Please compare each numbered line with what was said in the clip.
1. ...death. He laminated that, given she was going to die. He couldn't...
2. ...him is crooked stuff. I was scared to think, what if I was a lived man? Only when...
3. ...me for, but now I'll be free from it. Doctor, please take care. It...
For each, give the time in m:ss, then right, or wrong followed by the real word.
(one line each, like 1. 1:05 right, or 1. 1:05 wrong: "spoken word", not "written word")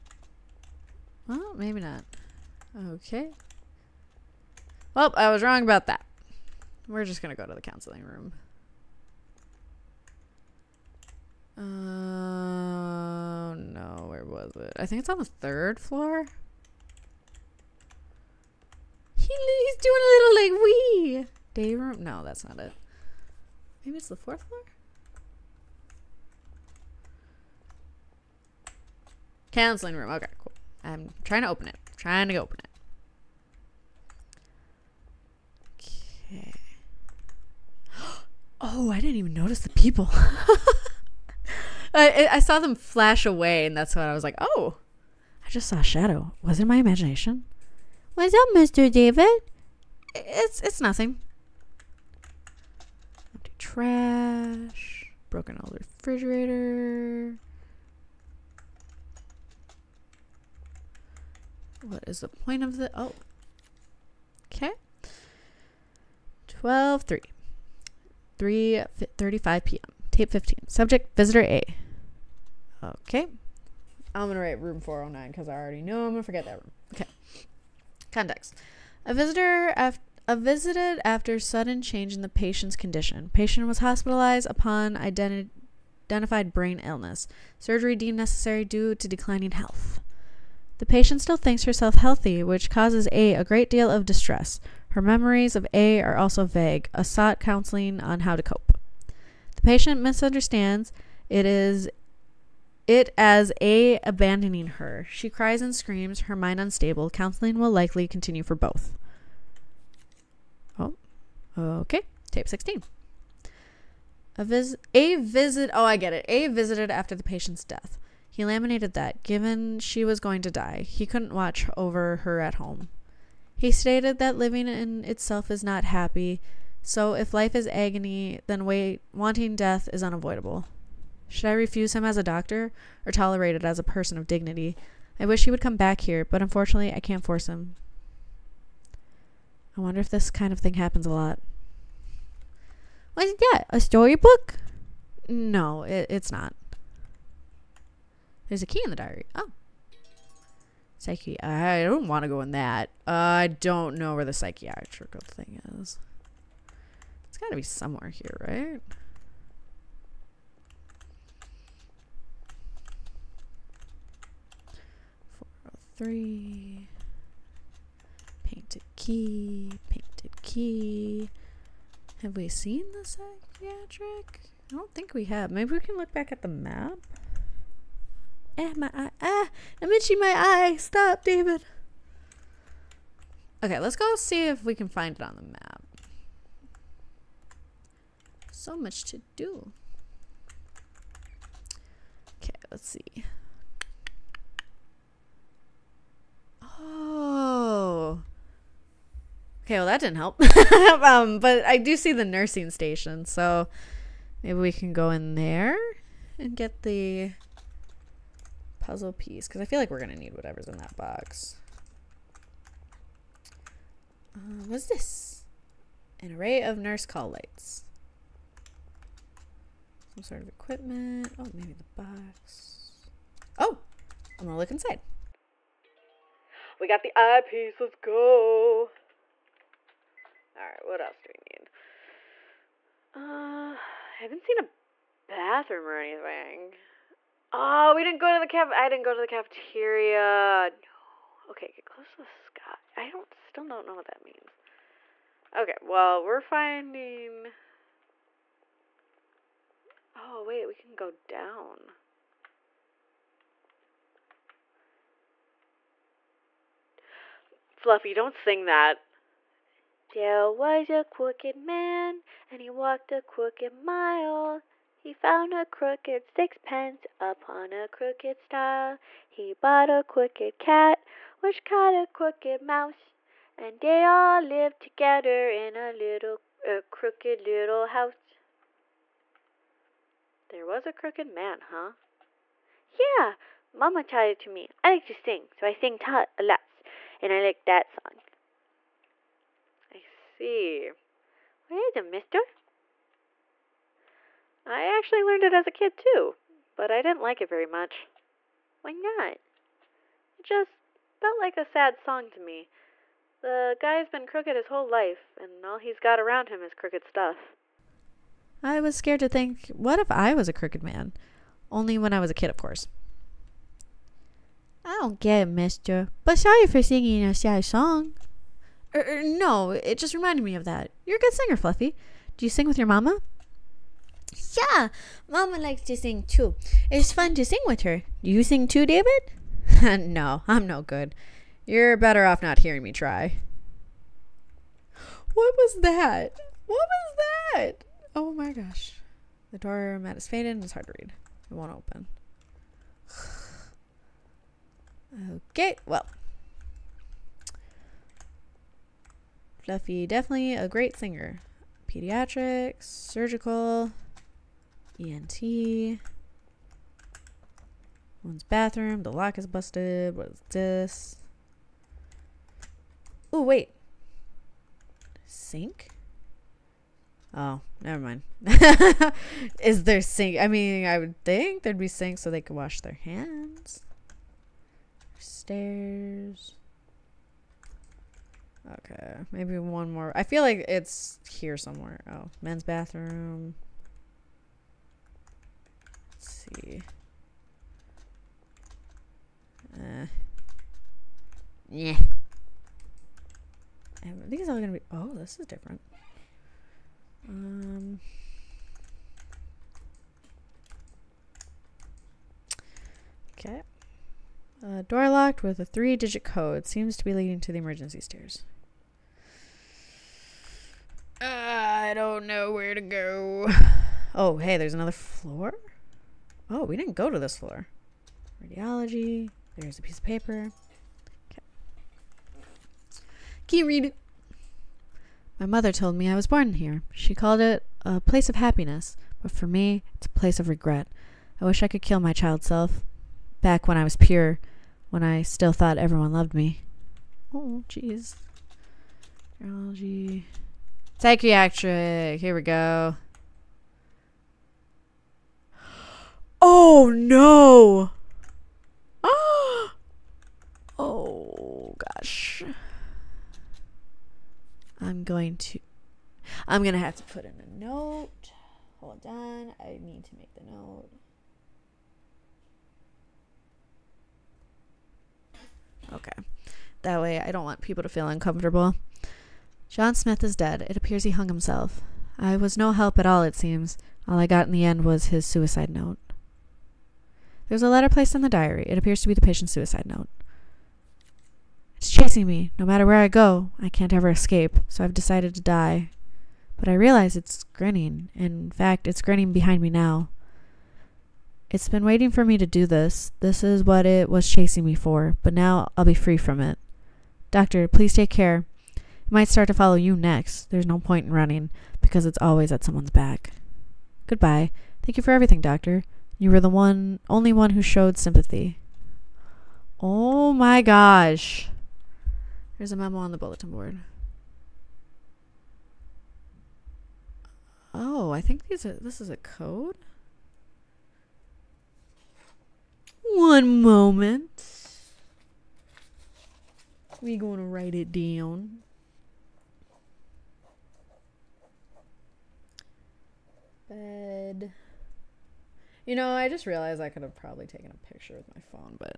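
1. 1:57 right
2. 5:06 wrong: "crooked", not "lived"
3. 8:14 right.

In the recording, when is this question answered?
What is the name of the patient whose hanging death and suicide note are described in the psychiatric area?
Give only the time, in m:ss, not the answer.
7:49.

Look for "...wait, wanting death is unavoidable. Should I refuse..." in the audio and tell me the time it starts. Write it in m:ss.
2:08.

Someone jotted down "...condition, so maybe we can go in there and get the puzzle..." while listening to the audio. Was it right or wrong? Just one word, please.
wrong.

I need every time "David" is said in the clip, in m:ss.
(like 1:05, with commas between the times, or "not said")
0:48, 3:01, 5:28.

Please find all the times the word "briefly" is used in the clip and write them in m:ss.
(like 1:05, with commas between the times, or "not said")
not said.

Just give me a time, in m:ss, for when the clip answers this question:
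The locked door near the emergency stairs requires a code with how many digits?
6:45.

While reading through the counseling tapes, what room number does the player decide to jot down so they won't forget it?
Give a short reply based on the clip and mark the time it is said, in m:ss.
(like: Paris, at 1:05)
409, at 1:14.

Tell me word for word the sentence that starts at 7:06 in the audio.
She called it a place of happiness, but for me, it's a place of regret.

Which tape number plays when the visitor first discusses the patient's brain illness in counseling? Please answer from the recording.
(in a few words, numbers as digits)
15.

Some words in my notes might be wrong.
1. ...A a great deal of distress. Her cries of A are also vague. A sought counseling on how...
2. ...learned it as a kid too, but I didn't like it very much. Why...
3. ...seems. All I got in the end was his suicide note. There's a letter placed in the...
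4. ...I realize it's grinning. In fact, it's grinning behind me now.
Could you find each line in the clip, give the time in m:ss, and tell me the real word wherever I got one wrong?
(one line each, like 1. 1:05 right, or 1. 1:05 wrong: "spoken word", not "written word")
1. 1:33 wrong: "memories", not "cries"
2. 4:55 right
3. 7:53 right
4. 8:06 right.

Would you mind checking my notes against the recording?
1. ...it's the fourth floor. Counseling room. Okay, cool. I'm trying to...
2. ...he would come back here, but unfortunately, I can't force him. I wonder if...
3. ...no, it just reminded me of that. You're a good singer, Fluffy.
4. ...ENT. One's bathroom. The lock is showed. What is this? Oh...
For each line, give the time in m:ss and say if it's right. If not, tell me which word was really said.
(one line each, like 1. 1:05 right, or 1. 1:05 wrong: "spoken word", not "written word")
1. 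0:23 right
2. 2:15 right
3. 5:19 right
4. 5:55 wrong: "busted", not "showed".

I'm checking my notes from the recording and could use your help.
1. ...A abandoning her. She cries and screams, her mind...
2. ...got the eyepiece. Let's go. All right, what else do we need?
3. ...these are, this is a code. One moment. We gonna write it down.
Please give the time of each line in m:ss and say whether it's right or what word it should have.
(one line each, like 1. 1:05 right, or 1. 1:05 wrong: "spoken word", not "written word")
1. 1:43 right
2. 3:46 right
3. 8:38 right.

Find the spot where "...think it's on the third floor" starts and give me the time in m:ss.
0:14.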